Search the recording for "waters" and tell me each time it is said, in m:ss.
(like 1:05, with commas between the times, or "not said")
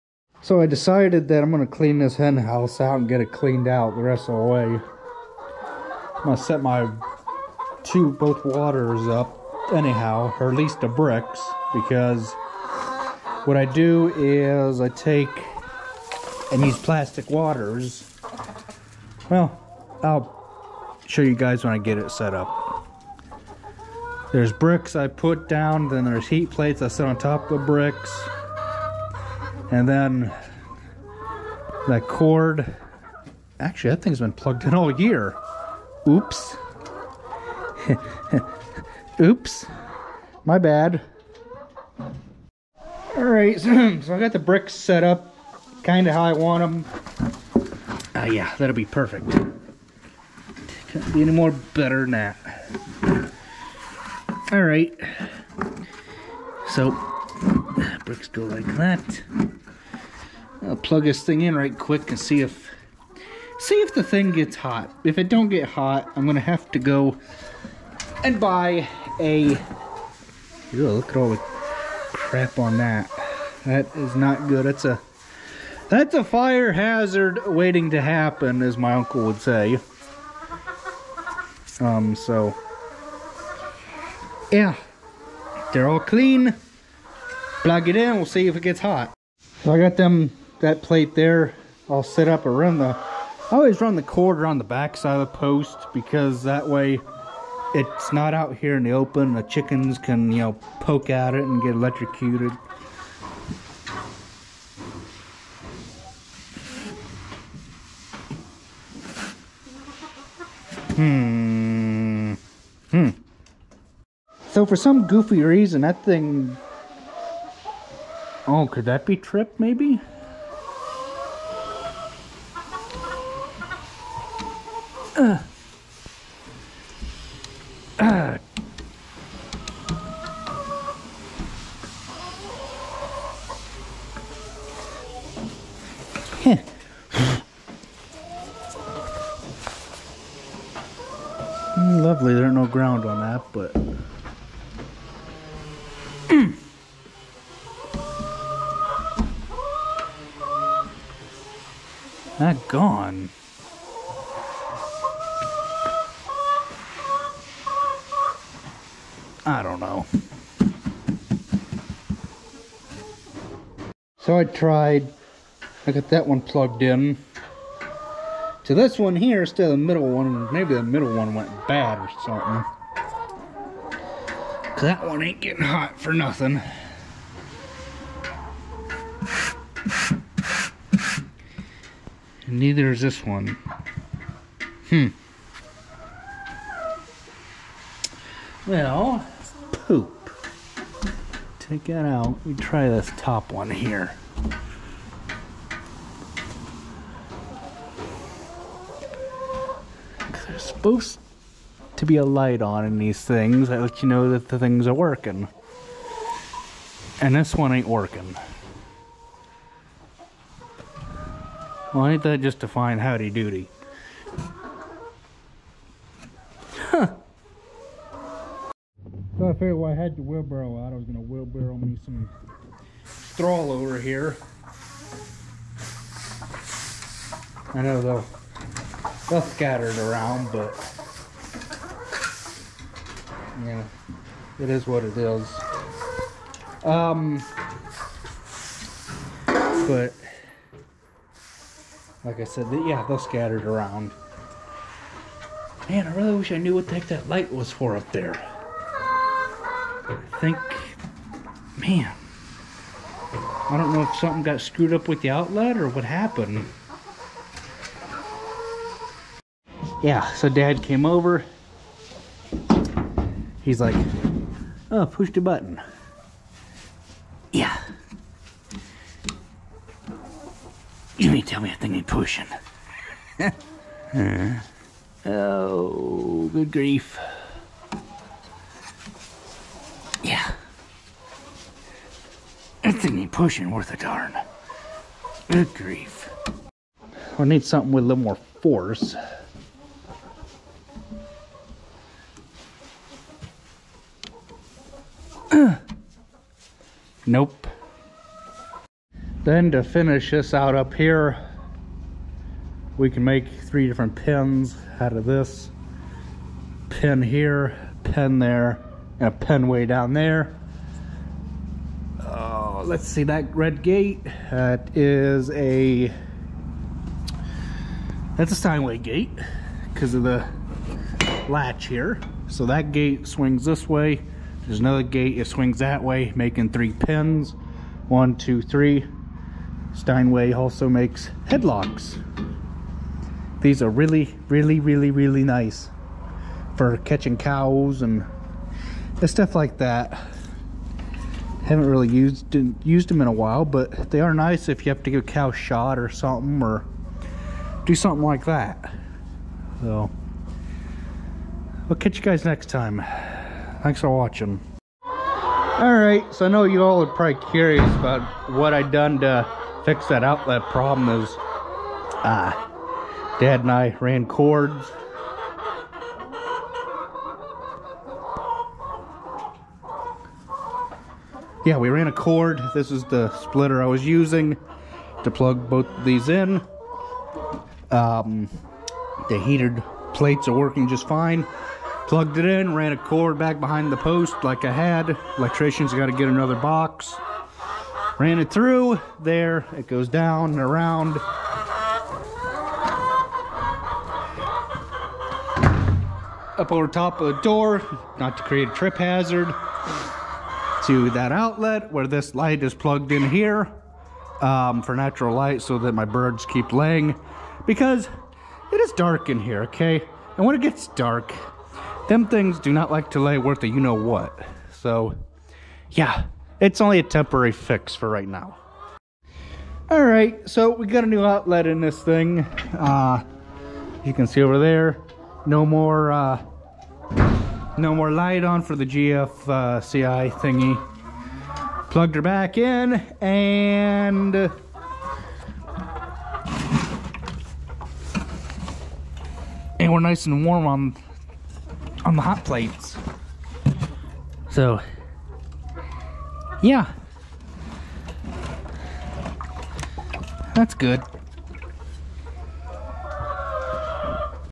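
0:08, 0:17.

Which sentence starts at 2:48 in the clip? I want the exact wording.
To this one here, Still the middle one, maybe the middle one went bad or something.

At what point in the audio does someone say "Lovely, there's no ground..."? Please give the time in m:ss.
2:21.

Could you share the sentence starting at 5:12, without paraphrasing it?
Uh, let's see that red gate.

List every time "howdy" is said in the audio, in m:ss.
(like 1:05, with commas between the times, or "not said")
3:33.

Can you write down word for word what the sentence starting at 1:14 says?
That's a that's a fire hazard waiting to happen, as my uncle would say.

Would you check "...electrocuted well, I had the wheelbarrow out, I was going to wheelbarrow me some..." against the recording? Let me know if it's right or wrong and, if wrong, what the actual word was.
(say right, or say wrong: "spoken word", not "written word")
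wrong: "figured", not "electrocuted".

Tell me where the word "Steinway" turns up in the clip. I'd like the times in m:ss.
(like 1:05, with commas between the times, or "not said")
5:18, 5:29.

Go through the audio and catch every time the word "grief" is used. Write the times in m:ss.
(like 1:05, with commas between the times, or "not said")
4:36, 4:45.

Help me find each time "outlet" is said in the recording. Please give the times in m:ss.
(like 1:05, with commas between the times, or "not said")
4:15, 6:00, 6:41, 7:01.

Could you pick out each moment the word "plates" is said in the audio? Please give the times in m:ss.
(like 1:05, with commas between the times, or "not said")
0:26, 1:30, 6:20, 7:22.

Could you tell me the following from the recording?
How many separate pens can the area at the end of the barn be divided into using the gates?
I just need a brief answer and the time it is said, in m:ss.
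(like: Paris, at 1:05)
3, at 5:03.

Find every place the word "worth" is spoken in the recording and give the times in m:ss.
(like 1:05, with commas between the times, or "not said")
4:43, 6:53.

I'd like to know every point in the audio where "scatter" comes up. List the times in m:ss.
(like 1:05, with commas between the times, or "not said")
3:49, 4:03.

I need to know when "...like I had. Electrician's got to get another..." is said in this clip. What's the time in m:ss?
6:24.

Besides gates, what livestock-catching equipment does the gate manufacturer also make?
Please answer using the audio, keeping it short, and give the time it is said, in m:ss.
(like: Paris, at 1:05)
Headlocks, at 5:29.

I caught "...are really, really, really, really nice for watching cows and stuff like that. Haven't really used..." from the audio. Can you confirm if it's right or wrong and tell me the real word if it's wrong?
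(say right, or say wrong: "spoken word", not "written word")
wrong: "catching", not "watching".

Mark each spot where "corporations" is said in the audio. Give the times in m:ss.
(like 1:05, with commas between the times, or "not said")
not said.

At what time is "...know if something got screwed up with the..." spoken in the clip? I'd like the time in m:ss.
4:13.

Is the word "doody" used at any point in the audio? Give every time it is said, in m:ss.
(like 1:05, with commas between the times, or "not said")
3:33.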